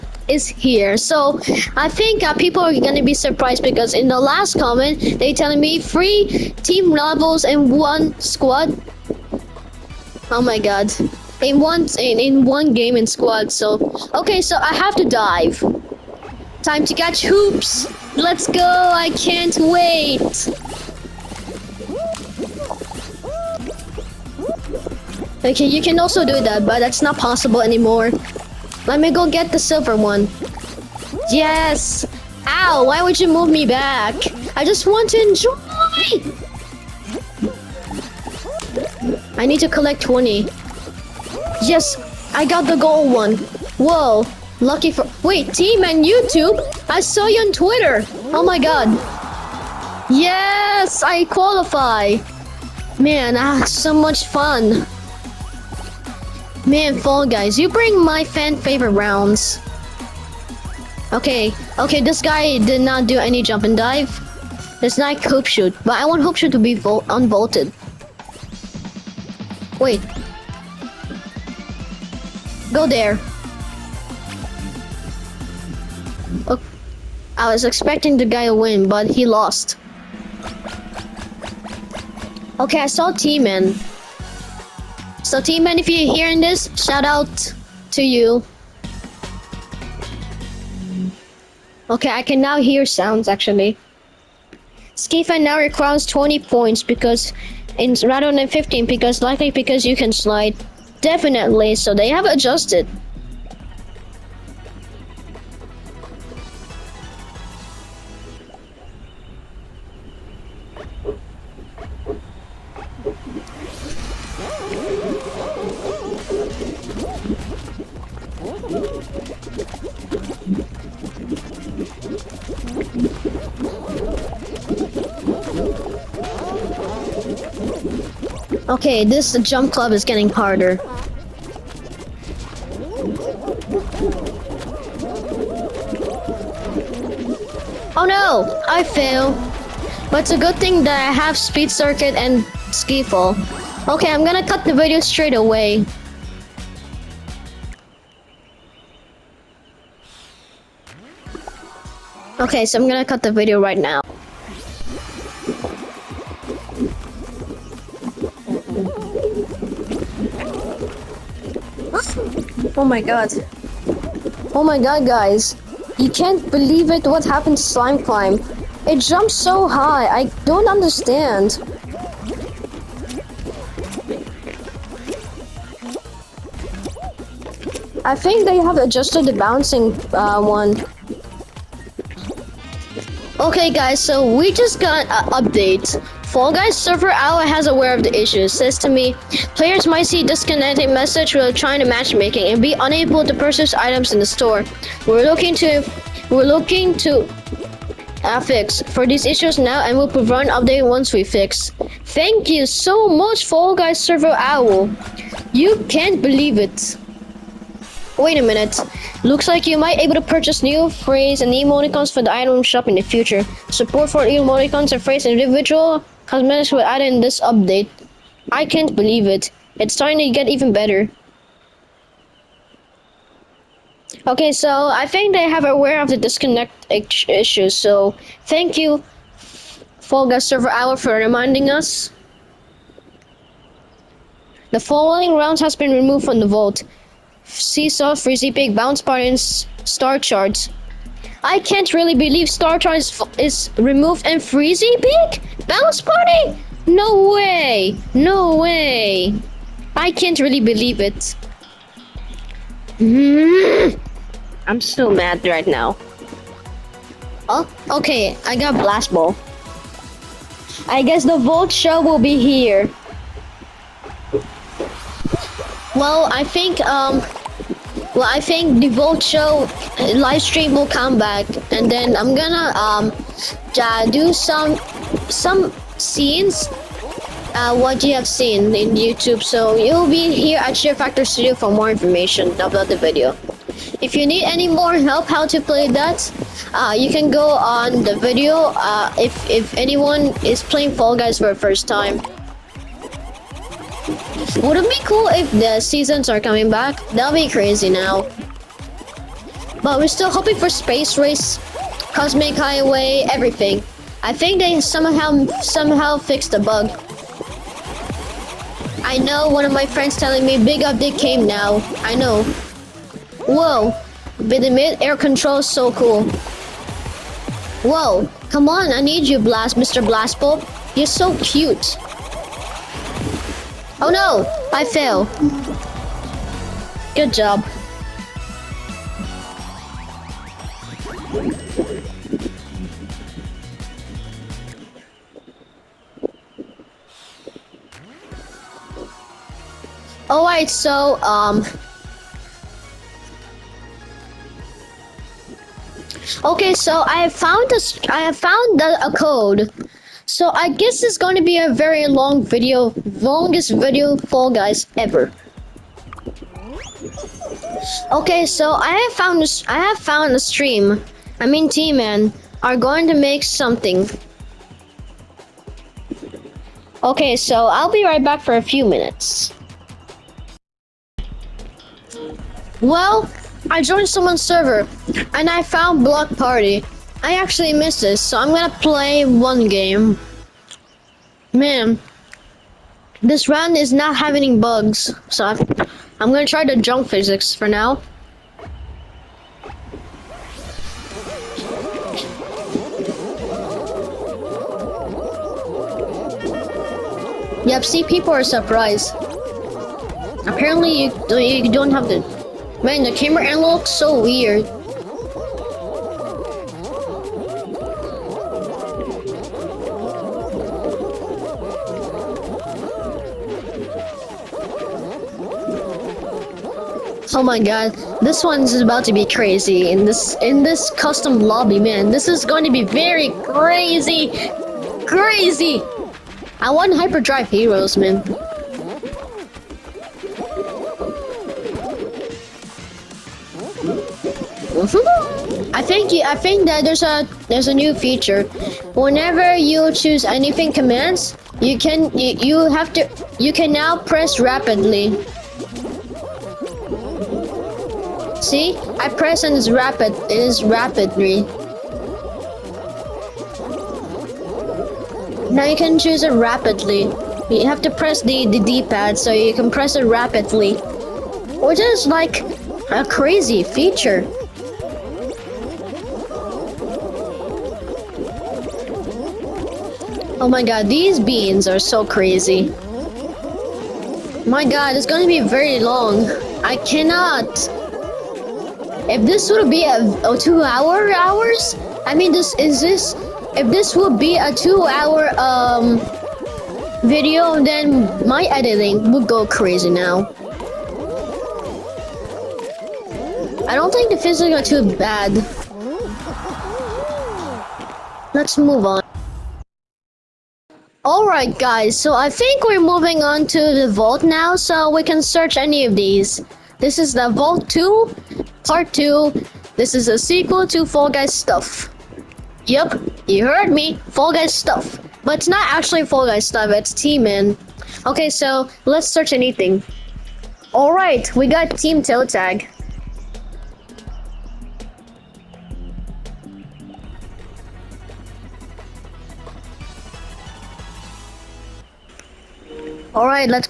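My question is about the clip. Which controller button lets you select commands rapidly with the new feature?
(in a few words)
D-pad.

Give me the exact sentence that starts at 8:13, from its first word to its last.
I don't think the physics are too bad.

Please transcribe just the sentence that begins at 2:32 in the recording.
Okay, so I'm gonna cut the video right now.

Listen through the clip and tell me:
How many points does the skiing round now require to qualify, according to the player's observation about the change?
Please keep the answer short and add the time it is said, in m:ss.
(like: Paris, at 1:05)
20, at 1:36.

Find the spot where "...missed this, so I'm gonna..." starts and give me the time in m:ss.
6:17.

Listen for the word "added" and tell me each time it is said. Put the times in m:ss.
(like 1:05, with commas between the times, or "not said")
3:36.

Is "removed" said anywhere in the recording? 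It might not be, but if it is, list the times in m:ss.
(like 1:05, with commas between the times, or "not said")
3:55, 4:03.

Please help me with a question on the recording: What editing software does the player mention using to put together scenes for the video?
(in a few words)
Share Factory Studio.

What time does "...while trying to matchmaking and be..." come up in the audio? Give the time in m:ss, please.
3:11.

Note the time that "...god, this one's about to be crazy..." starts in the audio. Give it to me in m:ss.
6:57.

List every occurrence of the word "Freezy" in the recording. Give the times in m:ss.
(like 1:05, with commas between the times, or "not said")
3:58, 4:04.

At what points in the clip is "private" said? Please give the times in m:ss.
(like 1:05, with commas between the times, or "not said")
not said.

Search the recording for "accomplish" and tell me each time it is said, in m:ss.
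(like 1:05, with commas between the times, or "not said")
not said.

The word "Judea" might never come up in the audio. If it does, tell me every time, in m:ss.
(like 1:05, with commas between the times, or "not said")
not said.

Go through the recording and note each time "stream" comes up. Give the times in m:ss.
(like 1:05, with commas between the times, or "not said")
4:30, 6:00.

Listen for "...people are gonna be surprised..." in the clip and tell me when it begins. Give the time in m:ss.
0:02.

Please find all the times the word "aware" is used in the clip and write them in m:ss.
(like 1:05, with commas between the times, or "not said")
3:07, 3:45.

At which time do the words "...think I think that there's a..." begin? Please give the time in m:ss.
7:15.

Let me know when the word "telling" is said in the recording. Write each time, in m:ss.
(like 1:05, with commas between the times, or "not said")
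0:05, 5:10.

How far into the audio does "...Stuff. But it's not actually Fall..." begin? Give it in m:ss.
8:34.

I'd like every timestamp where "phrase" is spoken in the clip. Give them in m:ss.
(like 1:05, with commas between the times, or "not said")
3:30, 3:35.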